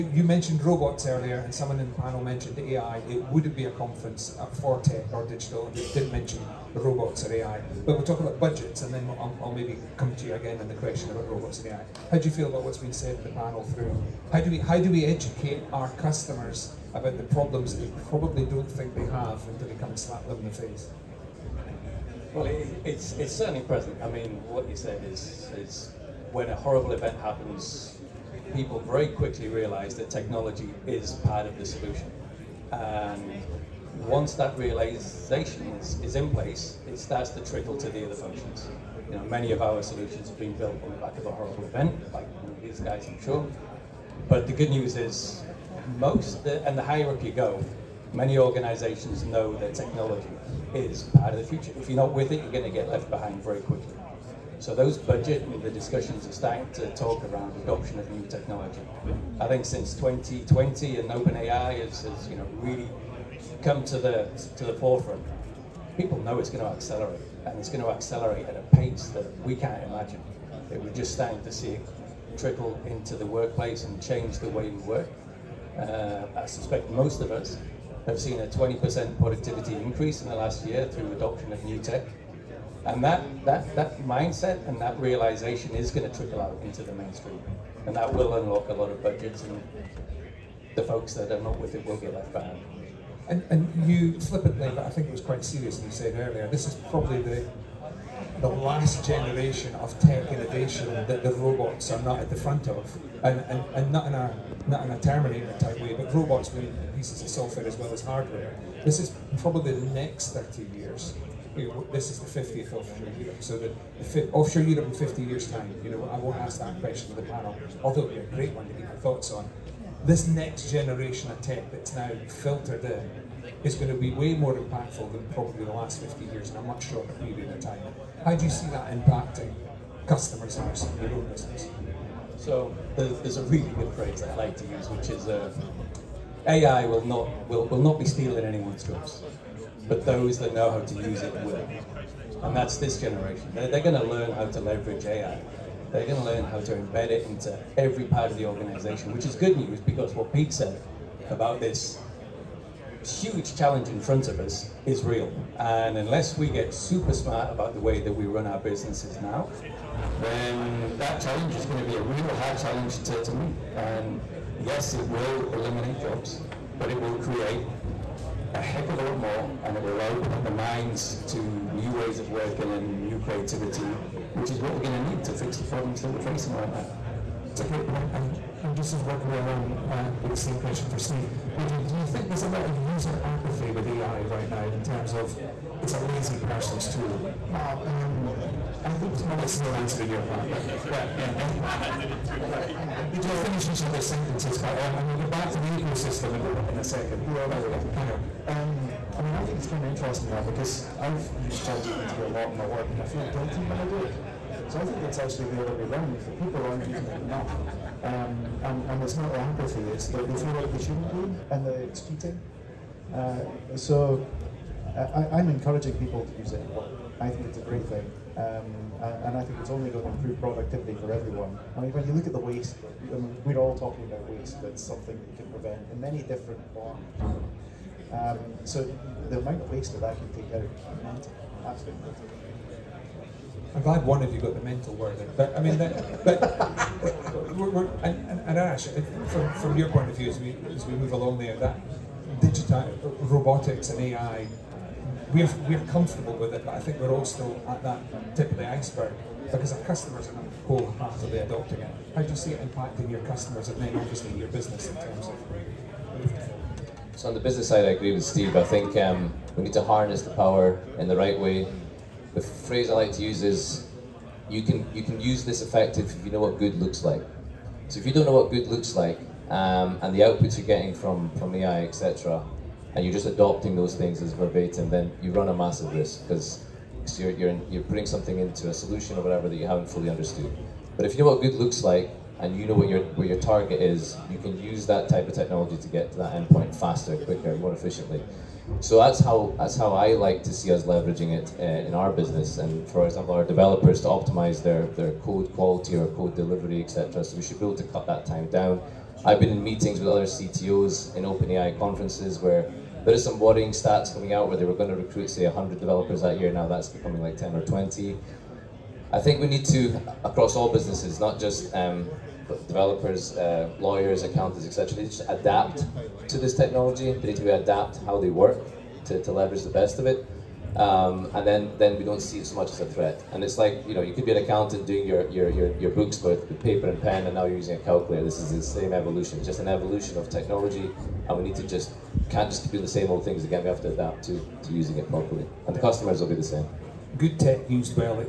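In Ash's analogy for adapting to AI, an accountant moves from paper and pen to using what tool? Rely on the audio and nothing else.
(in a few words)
A calculator.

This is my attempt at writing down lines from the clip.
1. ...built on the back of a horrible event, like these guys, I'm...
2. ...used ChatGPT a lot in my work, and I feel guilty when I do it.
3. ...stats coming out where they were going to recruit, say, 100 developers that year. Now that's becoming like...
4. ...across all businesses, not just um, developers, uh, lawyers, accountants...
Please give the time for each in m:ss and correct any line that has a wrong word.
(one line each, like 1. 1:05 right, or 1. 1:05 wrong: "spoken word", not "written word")
1. 0:40 right
2. 3:21 right
3. 5:03 right
4. 5:10 right.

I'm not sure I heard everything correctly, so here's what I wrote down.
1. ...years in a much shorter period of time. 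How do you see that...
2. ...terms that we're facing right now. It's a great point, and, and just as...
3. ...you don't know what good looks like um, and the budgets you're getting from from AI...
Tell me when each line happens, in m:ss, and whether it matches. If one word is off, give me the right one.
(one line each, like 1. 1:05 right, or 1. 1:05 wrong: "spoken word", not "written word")
1. 2:06 right
2. 2:55 wrong: "problems", not "terms"
3. 4:28 wrong: "outputs", not "budgets".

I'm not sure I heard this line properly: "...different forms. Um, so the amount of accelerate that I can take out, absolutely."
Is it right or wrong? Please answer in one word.
wrong.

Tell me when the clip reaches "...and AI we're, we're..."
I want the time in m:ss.
4:03.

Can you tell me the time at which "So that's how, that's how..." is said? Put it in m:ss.
4:48.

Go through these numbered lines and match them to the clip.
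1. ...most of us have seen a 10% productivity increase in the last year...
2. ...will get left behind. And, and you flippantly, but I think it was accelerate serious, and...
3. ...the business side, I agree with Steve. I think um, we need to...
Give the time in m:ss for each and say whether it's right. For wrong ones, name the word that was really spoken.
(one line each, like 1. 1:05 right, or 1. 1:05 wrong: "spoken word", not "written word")
1. 1:16 wrong: "20", not "10"
2. 1:31 wrong: "quite", not "accelerate"
3. 4:17 right.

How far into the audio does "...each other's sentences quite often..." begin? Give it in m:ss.
3:13.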